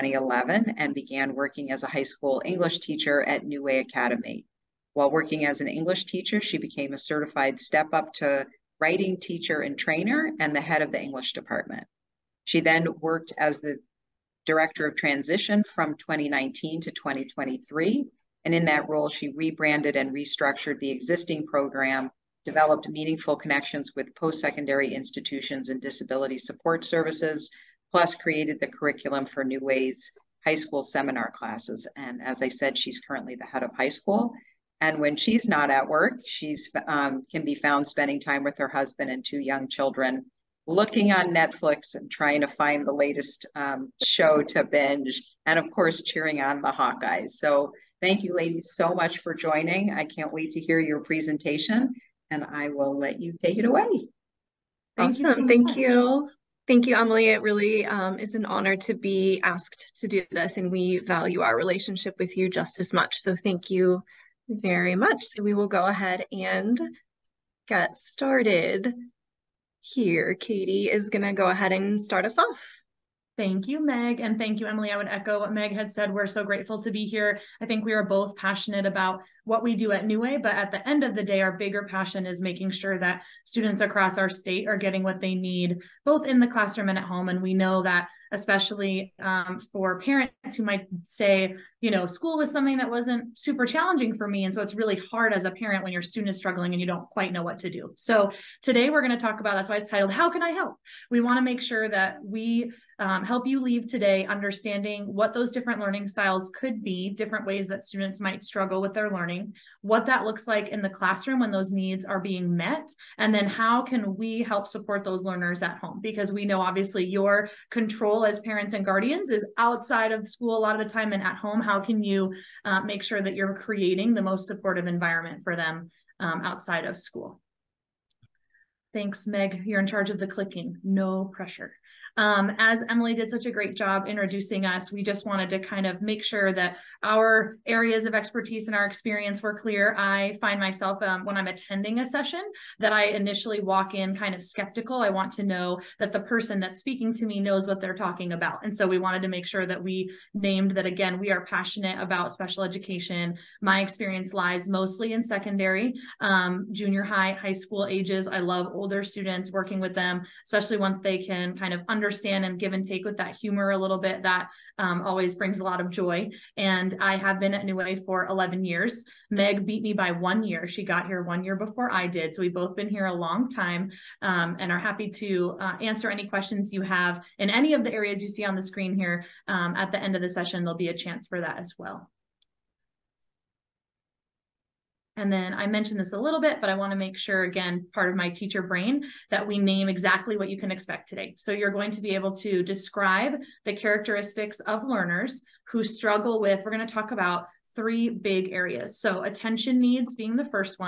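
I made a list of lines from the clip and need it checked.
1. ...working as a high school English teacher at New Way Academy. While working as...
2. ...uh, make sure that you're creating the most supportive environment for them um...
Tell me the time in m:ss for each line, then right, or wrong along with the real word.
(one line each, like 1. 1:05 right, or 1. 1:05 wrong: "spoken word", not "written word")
1. 0:01 right
2. 2:02 right.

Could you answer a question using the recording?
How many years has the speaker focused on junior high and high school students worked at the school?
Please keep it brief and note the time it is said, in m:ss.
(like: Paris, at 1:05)
11, at 2:48.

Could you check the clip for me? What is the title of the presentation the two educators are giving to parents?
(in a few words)
How Can I Help?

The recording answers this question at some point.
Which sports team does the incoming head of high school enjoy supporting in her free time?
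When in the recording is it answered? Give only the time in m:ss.
0:46.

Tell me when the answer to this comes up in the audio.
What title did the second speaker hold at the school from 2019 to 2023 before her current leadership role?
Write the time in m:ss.
0:14.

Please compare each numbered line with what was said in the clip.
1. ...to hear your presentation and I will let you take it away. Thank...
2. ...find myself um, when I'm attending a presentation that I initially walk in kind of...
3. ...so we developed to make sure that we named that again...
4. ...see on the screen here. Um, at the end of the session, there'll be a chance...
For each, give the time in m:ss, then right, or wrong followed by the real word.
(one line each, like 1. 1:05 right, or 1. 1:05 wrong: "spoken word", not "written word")
1. 0:50 right
2. 2:20 wrong: "session", not "presentation"
3. 2:28 wrong: "wanted", not "developed"
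4. 2:58 right.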